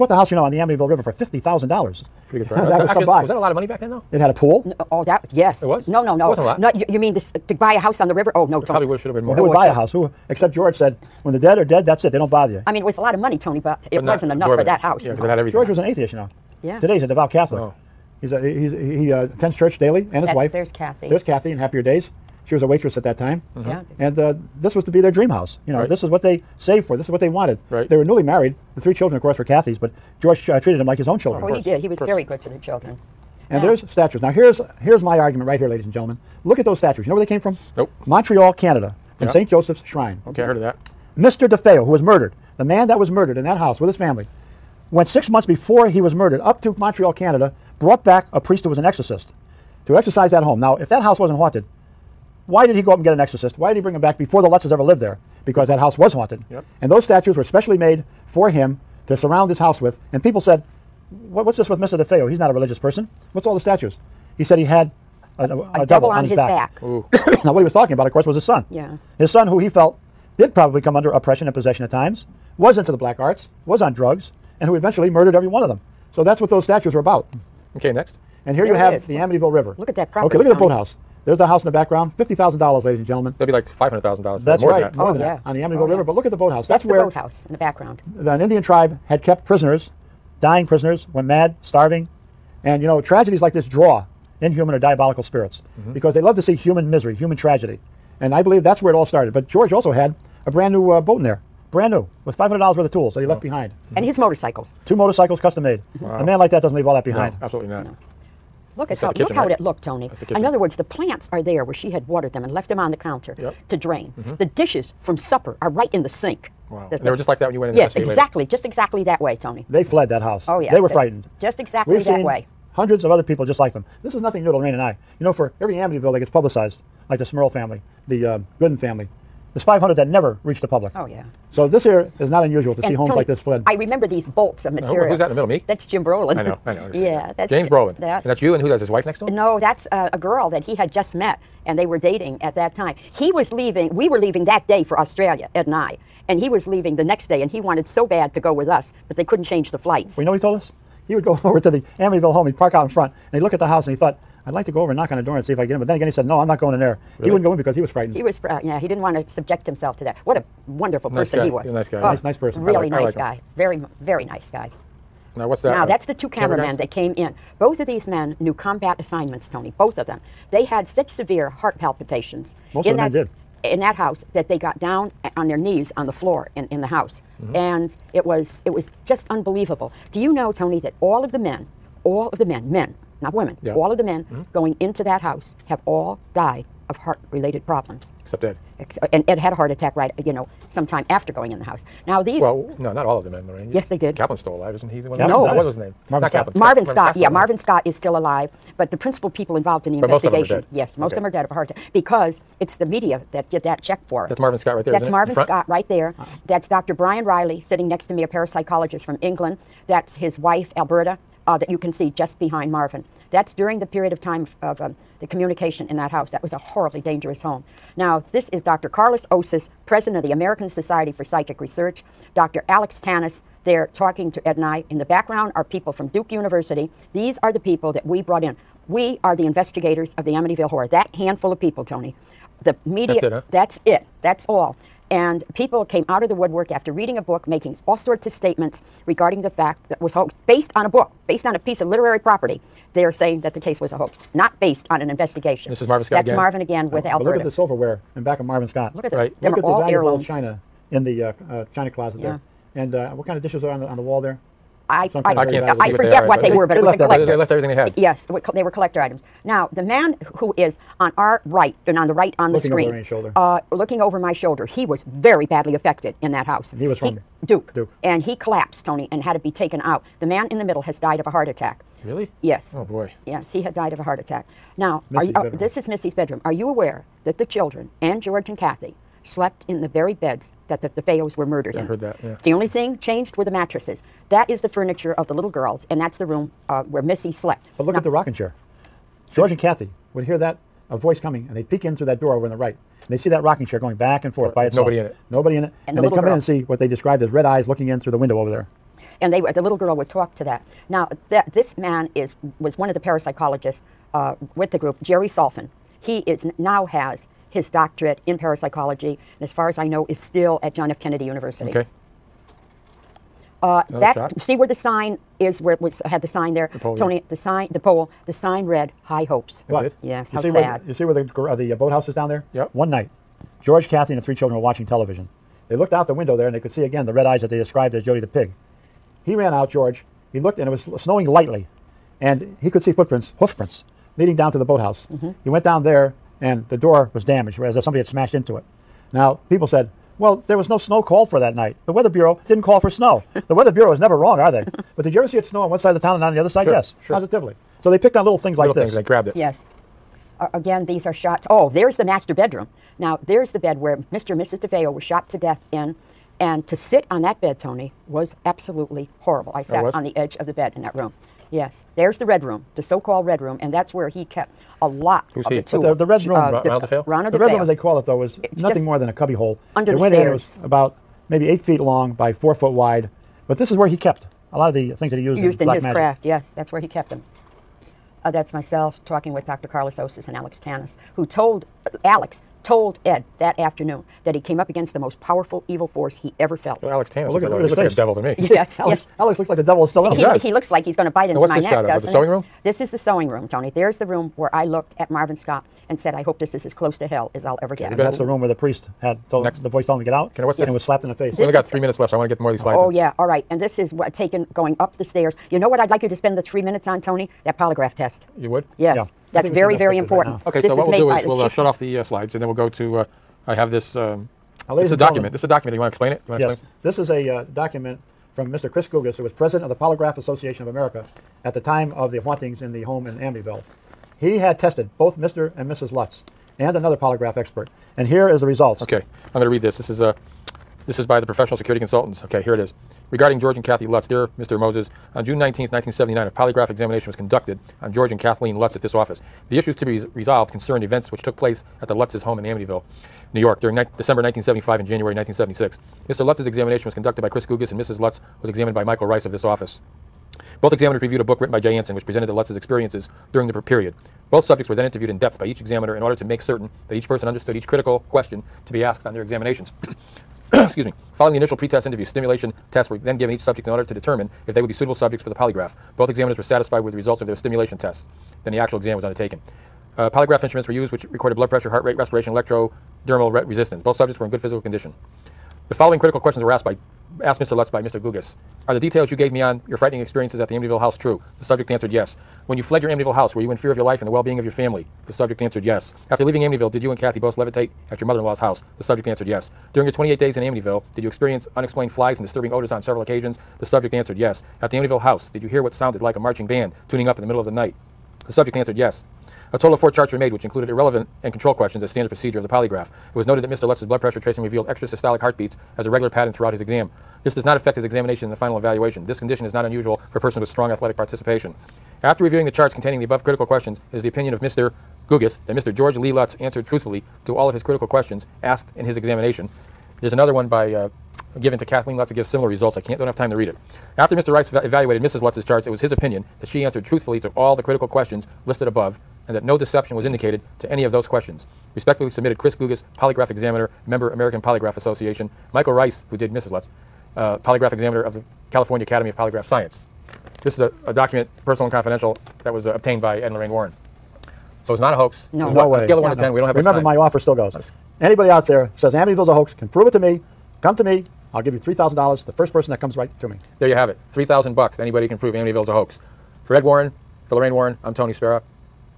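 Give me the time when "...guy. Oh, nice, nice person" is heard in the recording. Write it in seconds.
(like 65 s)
161 s.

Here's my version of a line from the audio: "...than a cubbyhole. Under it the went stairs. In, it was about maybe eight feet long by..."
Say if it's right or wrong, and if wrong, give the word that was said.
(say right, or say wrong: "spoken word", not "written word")
right.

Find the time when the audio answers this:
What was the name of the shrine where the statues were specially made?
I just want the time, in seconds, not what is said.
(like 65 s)
39 s.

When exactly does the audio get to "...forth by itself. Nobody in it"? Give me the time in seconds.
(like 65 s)
294 s.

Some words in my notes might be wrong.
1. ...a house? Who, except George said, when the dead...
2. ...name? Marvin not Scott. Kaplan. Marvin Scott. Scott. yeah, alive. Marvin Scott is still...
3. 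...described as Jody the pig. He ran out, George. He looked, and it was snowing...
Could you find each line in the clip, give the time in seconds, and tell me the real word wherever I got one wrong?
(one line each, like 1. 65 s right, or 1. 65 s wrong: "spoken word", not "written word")
1. 9 s right
2. 195 s right
3. 327 s right.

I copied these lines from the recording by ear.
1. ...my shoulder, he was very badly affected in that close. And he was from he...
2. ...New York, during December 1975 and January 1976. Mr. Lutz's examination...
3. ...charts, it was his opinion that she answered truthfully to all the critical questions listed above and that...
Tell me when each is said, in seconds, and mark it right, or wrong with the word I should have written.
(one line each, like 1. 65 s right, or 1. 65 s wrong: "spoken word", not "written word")
1. 264 s wrong: "house", not "close"
2. 443 s right
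3. 525 s right.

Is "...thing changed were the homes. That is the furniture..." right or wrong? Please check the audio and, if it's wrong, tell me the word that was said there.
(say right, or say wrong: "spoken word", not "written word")
wrong: "mattresses", not "homes".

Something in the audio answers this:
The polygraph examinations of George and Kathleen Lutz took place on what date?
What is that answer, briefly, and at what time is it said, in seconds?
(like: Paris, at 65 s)
June 19, 1979, at 435 s.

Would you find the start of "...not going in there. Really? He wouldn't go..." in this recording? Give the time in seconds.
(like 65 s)
156 s.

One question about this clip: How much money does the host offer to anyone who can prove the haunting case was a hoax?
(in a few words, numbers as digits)
$3,000.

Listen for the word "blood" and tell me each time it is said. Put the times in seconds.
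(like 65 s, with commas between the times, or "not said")
471 s, 503 s.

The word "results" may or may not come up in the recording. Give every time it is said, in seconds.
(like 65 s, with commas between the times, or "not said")
428 s, 466 s, 522 s.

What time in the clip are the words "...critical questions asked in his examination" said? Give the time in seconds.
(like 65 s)
517 s.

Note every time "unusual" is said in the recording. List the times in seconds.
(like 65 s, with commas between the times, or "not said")
132 s, 509 s.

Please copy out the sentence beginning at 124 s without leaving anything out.
This is nothing new to Lorraine and I.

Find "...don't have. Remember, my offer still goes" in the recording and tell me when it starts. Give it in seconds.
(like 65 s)
546 s.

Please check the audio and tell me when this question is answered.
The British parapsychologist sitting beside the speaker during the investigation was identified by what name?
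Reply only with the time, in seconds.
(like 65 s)
206 s.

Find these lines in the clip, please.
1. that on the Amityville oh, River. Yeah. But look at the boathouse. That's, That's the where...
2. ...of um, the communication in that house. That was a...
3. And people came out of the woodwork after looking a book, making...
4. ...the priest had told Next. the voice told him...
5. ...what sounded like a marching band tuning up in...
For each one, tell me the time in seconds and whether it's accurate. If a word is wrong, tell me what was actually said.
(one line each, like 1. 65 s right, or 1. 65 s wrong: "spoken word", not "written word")
1. 85 s right
2. 214 s right
3. 235 s wrong: "reading", not "looking"
4. 398 s right
5. 495 s right.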